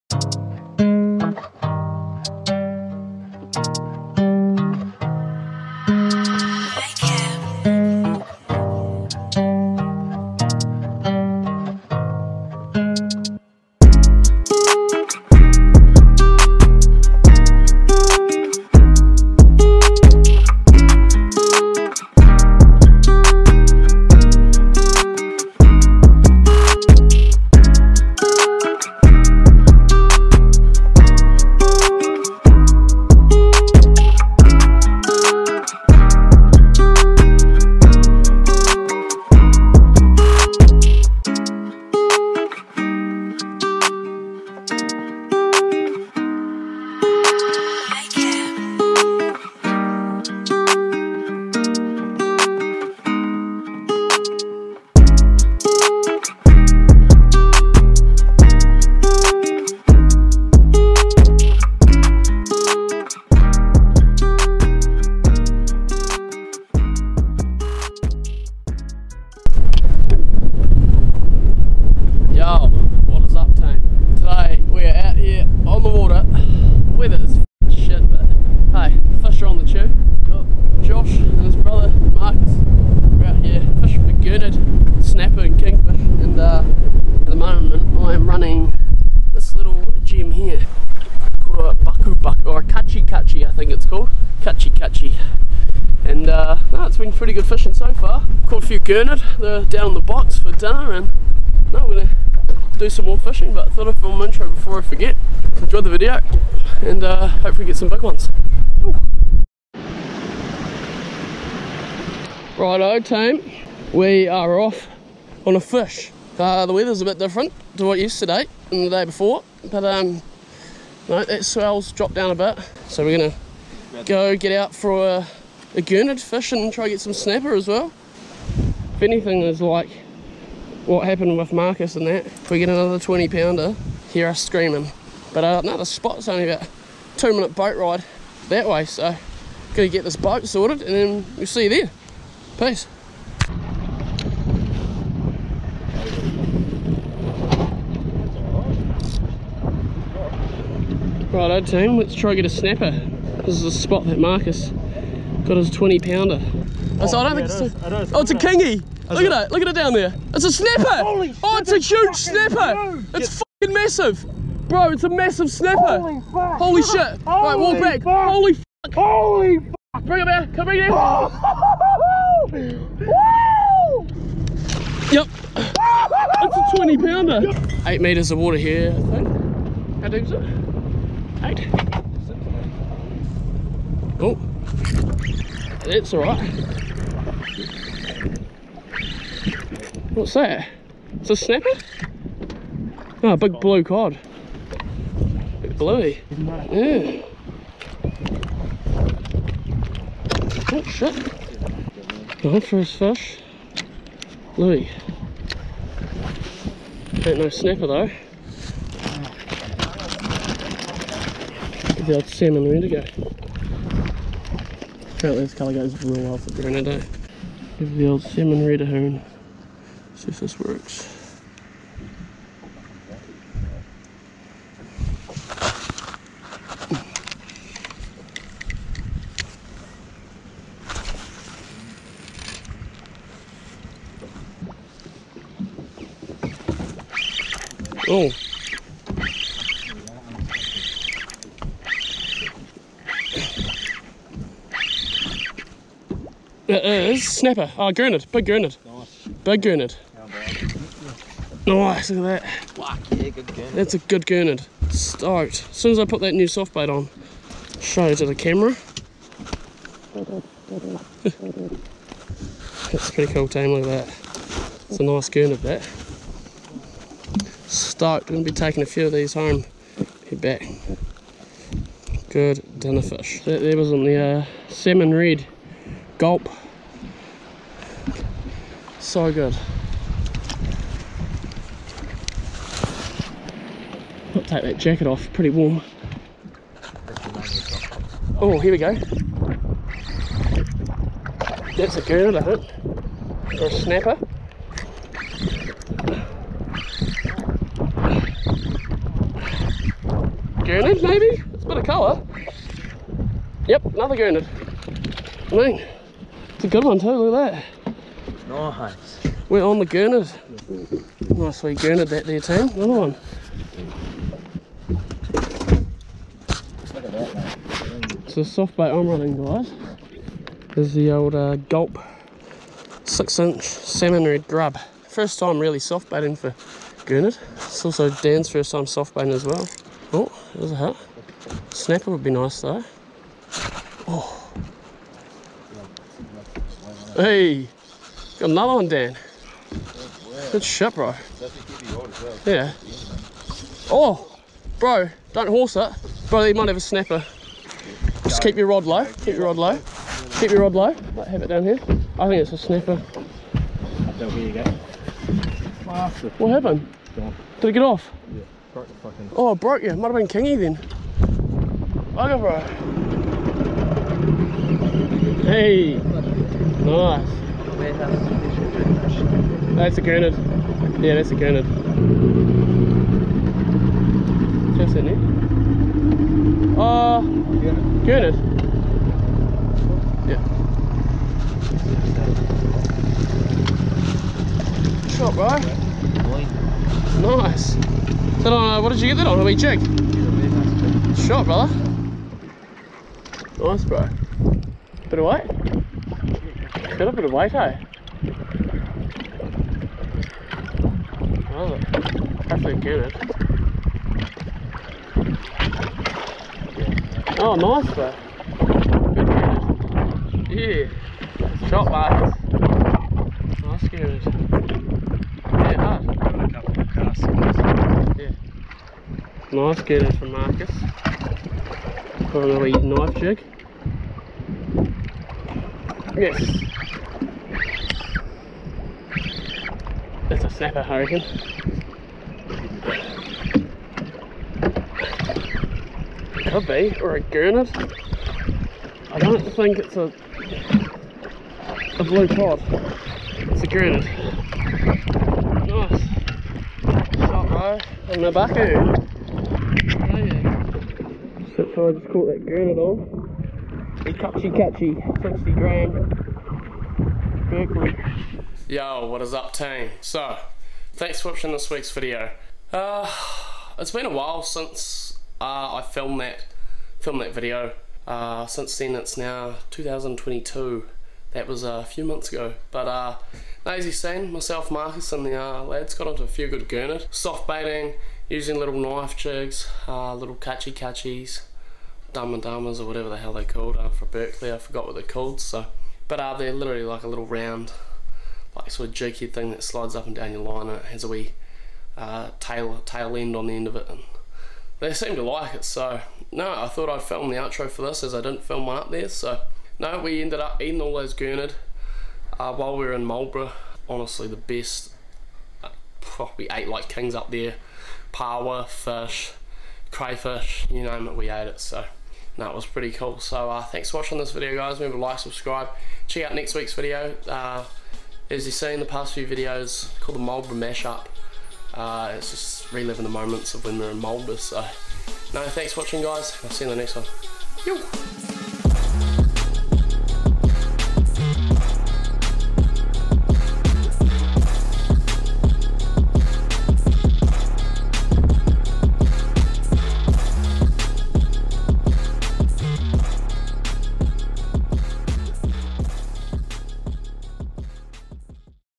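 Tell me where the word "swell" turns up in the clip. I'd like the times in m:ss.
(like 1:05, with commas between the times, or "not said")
2:01.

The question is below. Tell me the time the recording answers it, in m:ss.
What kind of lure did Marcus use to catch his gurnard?
7:02.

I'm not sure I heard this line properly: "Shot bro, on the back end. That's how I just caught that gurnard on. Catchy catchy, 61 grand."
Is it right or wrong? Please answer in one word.
wrong.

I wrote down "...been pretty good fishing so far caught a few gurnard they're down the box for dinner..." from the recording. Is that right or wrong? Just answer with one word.
right.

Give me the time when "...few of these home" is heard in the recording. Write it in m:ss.
4:28.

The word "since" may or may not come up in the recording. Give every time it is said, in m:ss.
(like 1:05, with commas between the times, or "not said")
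7:44, 7:48.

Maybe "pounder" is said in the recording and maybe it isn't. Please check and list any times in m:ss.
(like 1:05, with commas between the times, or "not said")
2:13, 2:35, 2:56.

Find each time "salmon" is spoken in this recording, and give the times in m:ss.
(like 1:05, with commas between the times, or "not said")
3:32, 3:38, 4:34, 5:23.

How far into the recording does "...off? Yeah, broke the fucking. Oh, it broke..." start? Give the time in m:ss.
5:57.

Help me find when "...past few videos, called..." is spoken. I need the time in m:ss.
8:38.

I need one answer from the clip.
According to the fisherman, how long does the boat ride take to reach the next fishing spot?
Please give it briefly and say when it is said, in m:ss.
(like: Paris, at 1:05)
2 minutes, at 2:17.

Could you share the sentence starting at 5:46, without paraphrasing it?
Bro, He might have a snapper.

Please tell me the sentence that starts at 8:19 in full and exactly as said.
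So no, we ended up eating all those gurnard uh, while we were in Marlborough.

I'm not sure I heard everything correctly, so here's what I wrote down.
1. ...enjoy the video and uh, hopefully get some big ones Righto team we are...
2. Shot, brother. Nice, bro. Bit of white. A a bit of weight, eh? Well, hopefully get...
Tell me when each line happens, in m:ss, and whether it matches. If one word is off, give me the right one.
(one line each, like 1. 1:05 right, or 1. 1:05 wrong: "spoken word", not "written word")
1. 1:45 right
2. 6:31 right.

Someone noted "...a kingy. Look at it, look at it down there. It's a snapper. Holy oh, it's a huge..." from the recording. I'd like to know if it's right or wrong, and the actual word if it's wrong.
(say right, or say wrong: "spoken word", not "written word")
right.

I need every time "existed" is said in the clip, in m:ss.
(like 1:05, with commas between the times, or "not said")
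not said.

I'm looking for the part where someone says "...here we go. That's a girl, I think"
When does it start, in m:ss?
4:48.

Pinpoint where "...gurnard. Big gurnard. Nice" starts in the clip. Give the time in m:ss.
4:07.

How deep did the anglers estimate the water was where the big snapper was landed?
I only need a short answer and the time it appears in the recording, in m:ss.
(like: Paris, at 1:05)
8 meters, at 2:57.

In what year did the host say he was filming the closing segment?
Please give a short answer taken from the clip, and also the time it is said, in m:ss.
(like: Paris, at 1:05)
2022, at 7:49.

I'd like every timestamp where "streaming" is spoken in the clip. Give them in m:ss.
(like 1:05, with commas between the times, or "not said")
not said.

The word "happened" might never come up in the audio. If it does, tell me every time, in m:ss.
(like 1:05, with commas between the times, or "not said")
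2:11, 5:56.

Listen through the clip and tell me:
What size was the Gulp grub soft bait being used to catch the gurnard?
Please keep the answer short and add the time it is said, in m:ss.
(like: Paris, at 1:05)
6 inch, at 5:23.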